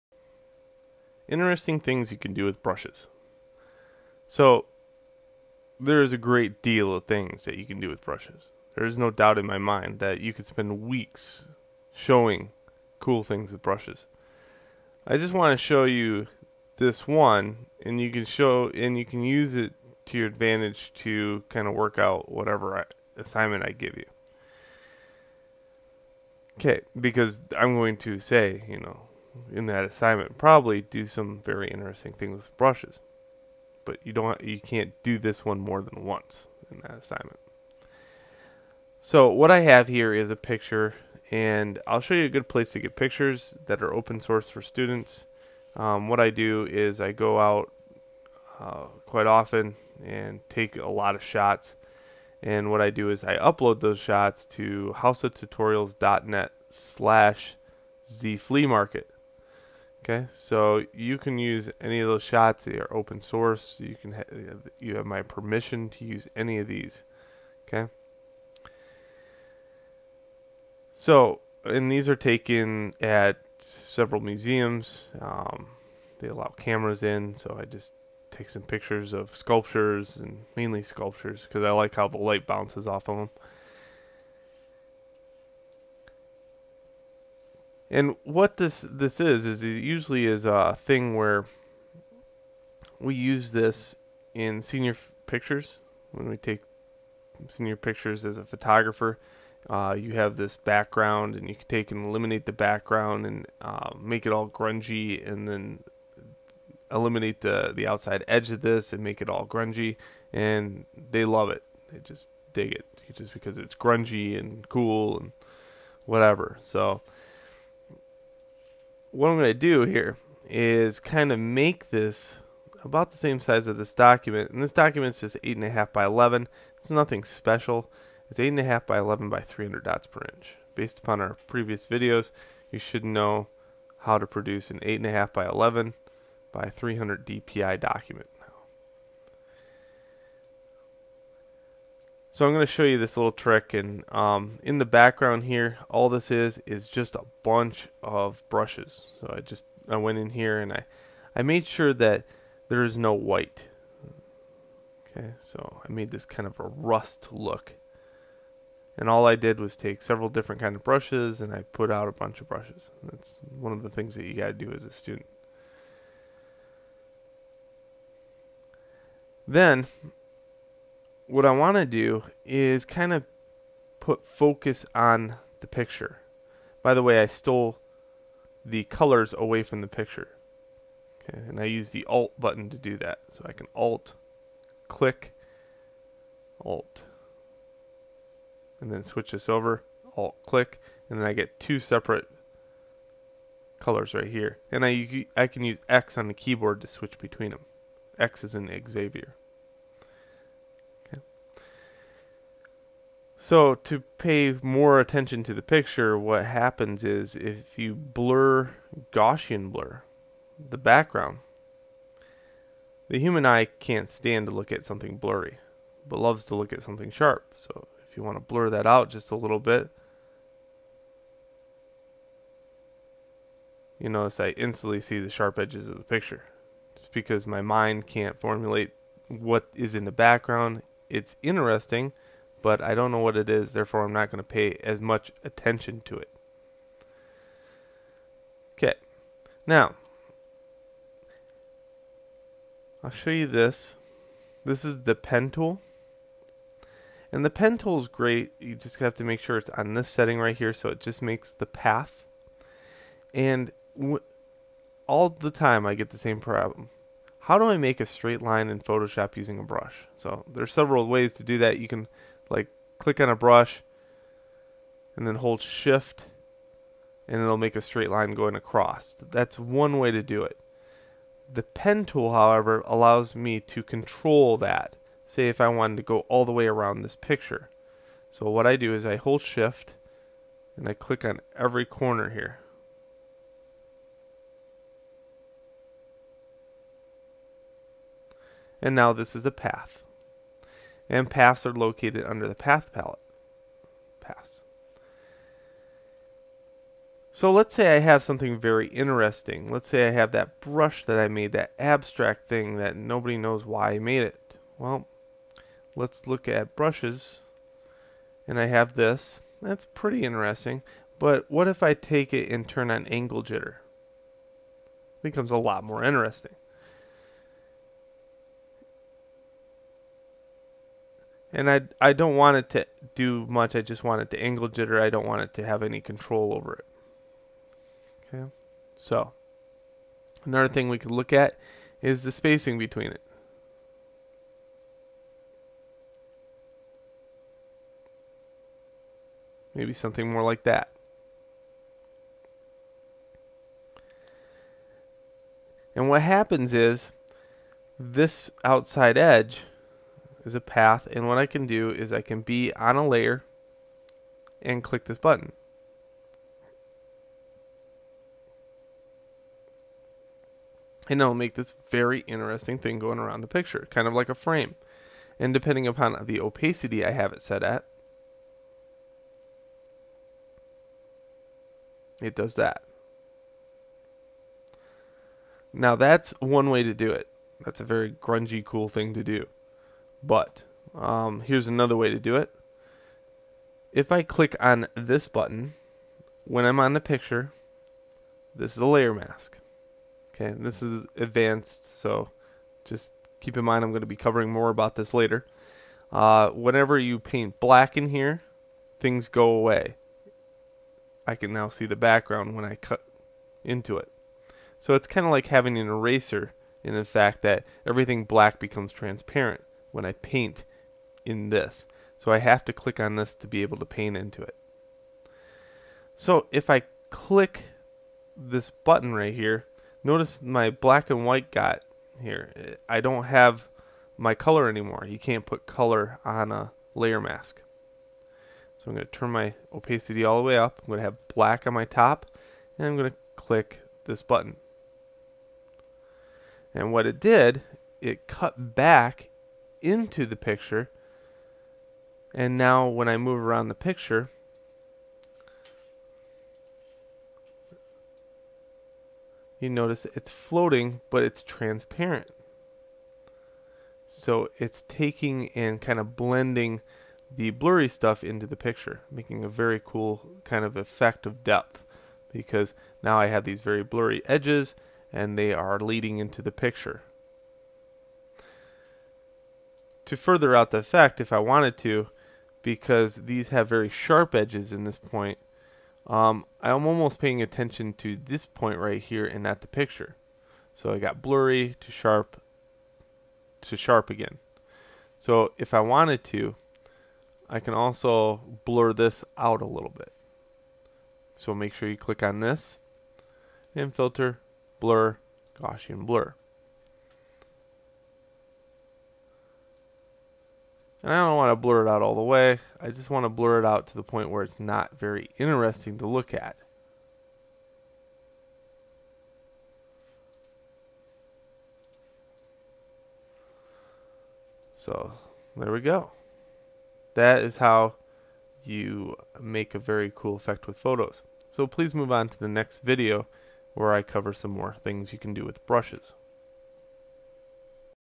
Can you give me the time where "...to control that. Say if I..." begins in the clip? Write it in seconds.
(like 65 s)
273 s.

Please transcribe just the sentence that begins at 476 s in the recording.
Um, I'm almost paying attention to this point right here and not the picture.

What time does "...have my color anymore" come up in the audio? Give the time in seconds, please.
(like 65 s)
423 s.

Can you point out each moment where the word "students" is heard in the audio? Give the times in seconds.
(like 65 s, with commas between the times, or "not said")
44 s, 164 s.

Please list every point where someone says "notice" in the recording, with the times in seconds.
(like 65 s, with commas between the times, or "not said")
224 s, 420 s, 449 s.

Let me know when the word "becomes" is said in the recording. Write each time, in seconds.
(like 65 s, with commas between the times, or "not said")
315 s, 408 s.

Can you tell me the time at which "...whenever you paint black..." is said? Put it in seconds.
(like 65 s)
396 s.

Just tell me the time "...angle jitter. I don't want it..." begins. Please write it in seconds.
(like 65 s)
324 s.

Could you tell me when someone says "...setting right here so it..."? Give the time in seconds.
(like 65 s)
250 s.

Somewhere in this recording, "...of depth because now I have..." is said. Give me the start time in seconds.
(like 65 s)
461 s.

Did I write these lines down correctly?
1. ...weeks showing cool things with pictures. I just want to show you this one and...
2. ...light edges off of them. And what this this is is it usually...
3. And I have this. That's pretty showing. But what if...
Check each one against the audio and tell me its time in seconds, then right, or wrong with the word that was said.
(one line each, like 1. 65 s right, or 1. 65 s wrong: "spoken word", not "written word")
1. 10 s wrong: "brushes", not "pictures"
2. 82 s wrong: "bounces", not "edges"
3. 308 s wrong: "interesting", not "showing".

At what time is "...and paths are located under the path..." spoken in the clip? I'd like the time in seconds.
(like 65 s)
291 s.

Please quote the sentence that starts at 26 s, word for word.
Okay, because I'm going to say, you know, in that assignment probably do some very interesting things with brushes.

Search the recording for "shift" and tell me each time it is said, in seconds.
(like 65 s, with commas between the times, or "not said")
265 s, 279 s.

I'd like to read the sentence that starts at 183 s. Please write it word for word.
So I can Alt, click, Alt, and then switch this over, Alt, click, and then I get two separate colors right here.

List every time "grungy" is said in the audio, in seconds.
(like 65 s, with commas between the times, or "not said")
104 s, 109 s, 113 s, 378 s.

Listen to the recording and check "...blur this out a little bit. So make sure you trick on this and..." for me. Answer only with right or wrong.
wrong.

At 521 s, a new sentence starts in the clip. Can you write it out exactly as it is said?
So please move on to the next video where I cover some more things you can do with brushes.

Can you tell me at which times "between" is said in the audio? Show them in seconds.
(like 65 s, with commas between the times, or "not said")
197 s, 332 s.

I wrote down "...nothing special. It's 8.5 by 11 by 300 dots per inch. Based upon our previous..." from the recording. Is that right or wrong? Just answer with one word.
right.